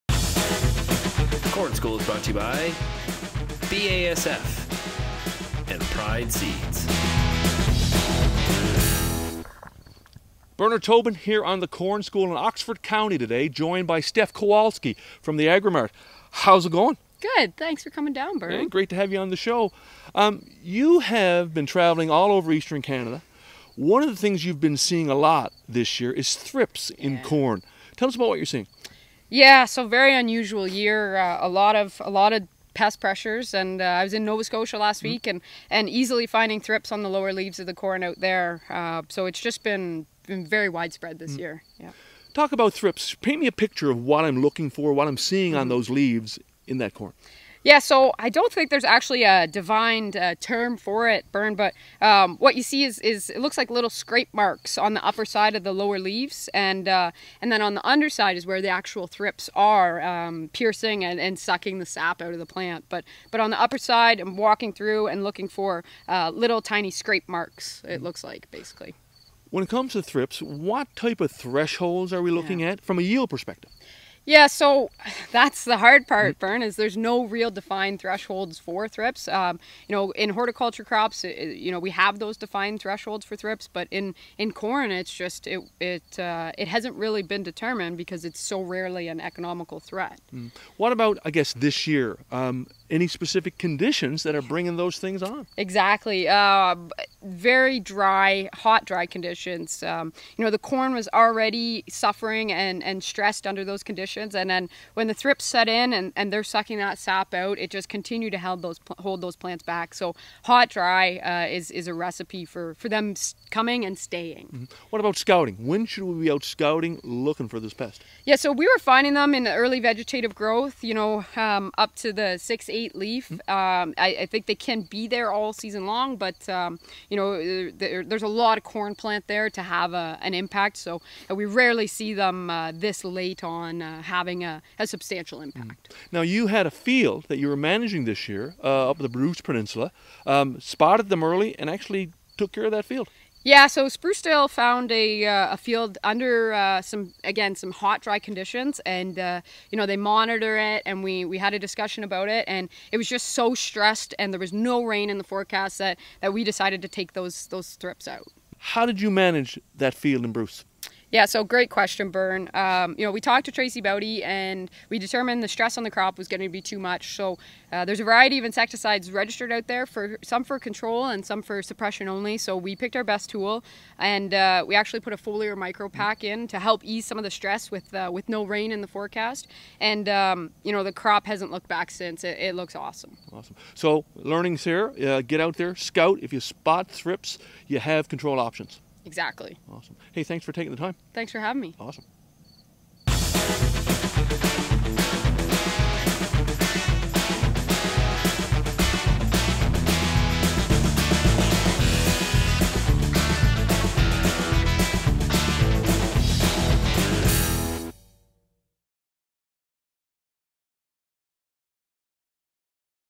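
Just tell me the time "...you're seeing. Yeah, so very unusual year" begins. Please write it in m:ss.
0:28.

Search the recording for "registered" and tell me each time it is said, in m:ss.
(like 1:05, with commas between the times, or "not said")
2:49.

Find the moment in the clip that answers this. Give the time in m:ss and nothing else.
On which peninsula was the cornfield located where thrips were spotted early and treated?
2:19.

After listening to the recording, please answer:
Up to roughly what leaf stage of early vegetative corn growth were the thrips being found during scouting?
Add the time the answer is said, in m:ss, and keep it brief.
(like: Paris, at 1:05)
six, eight leaf, at 2:02.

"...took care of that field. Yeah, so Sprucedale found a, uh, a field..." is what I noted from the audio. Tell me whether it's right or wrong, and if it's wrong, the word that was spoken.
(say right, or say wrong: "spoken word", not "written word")
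right.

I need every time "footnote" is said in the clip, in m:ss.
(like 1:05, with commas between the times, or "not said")
not said.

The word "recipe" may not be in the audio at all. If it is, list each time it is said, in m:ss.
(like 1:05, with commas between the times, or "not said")
1:51.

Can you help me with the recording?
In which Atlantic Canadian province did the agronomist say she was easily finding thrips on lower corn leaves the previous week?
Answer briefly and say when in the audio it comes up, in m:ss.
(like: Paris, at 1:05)
Nova Scotia, at 0:34.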